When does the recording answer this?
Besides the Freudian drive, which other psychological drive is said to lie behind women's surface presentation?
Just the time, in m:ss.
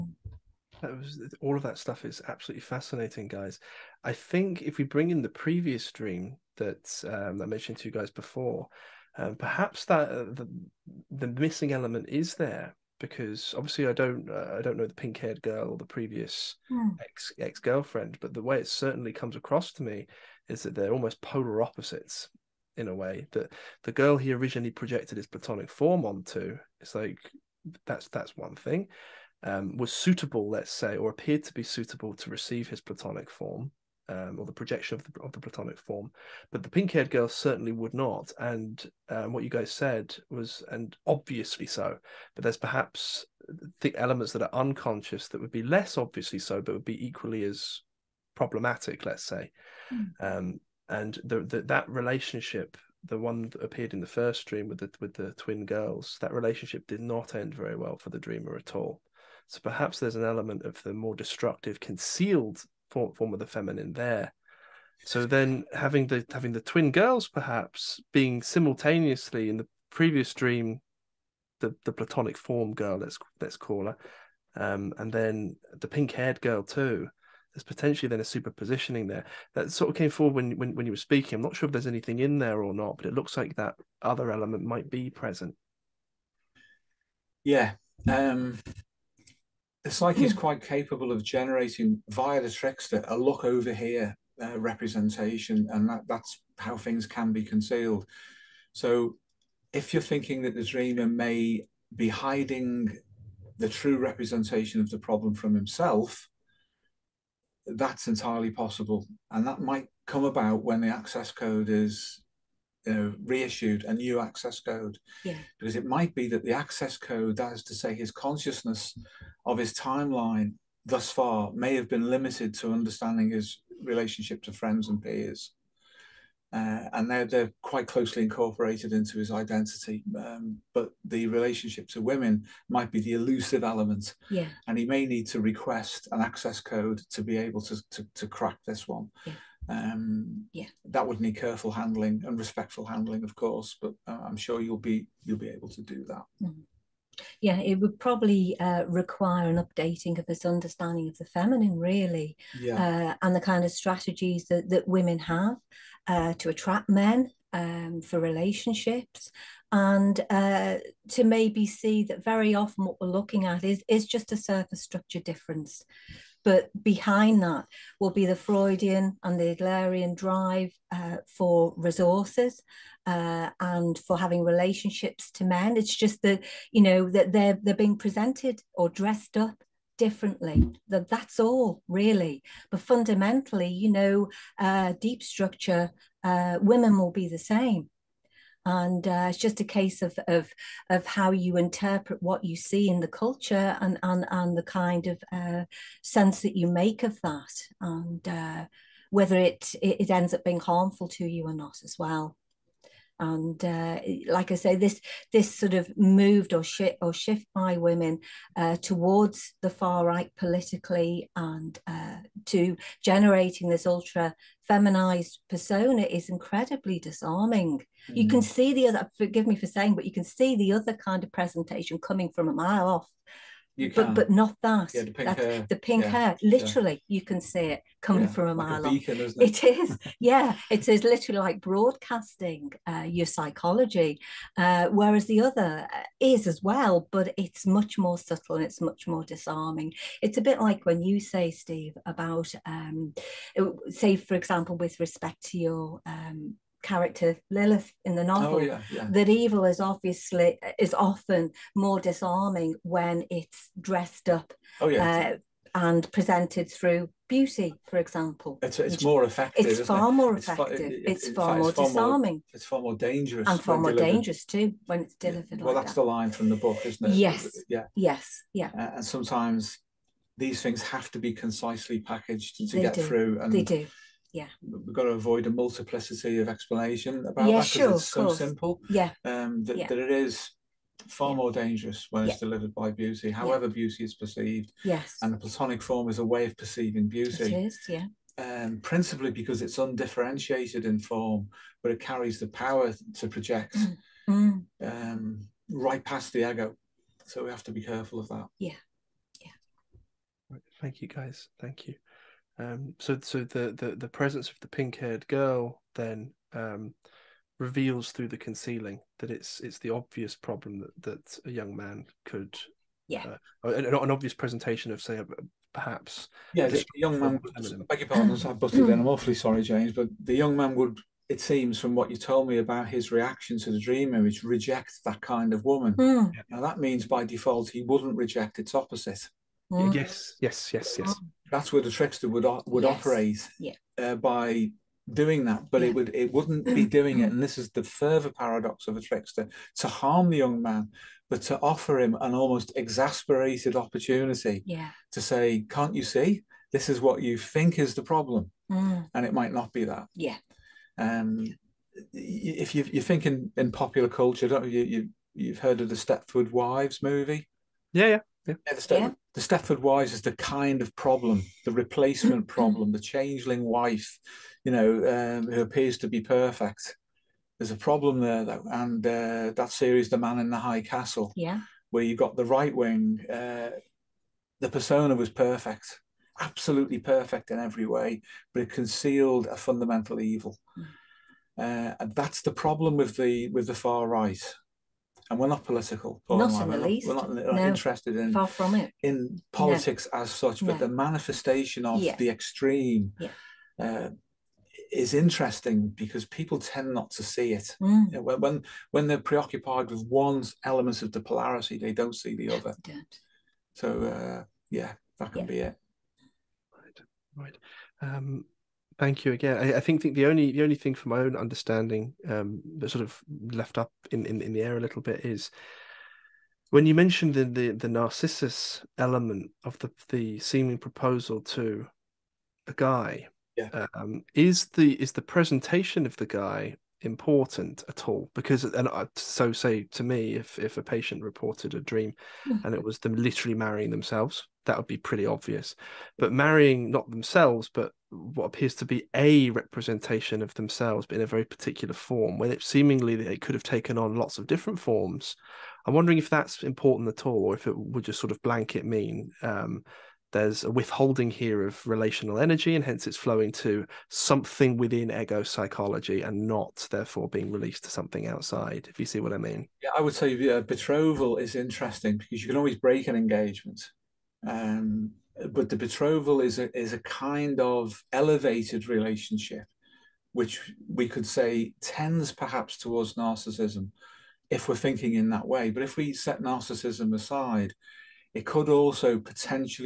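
2:49.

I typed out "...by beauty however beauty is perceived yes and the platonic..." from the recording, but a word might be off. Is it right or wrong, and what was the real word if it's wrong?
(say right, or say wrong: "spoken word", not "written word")
right.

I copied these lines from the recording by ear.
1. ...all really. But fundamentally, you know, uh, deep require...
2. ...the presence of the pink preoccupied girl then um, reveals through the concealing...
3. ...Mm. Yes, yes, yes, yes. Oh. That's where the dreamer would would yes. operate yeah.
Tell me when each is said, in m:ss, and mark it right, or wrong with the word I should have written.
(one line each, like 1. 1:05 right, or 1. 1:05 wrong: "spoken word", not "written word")
1. 3:01 wrong: "structure", not "require"
2. 5:03 wrong: "haired", not "preoccupied"
3. 5:29 wrong: "trickster", not "dreamer".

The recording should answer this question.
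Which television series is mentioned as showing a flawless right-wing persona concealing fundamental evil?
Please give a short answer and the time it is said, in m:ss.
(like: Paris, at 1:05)
The Man in the High Castle, at 6:10.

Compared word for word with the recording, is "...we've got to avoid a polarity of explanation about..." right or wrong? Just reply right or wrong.
wrong.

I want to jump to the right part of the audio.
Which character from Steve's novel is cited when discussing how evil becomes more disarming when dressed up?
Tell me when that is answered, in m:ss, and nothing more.
4:07.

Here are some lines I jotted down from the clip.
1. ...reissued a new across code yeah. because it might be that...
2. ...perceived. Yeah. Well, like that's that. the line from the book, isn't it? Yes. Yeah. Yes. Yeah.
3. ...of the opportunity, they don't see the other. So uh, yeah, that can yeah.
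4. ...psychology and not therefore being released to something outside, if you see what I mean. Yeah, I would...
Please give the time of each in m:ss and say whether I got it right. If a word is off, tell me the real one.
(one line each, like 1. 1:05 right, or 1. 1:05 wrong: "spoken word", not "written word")
1. 1:53 wrong: "access", not "across"
2. 4:25 wrong: "delivered", not "perceived"
3. 6:41 wrong: "polarity", not "opportunity"
4. 7:35 right.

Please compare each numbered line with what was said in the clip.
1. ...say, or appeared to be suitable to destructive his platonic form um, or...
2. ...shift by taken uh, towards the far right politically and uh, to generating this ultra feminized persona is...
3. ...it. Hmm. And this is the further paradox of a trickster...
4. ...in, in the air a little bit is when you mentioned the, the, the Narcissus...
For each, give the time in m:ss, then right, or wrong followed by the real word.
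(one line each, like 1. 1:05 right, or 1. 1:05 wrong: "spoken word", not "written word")
1. 0:30 wrong: "receive", not "destructive"
2. 3:27 wrong: "women", not "taken"
3. 5:37 right
4. 6:54 right.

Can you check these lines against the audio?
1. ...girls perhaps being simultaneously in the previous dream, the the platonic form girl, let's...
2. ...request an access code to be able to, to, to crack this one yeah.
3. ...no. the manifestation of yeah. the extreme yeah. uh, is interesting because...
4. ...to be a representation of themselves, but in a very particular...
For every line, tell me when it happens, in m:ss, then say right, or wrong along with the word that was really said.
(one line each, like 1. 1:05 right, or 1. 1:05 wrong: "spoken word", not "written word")
1. 1:06 right
2. 2:15 right
3. 6:30 right
4. 7:18 right.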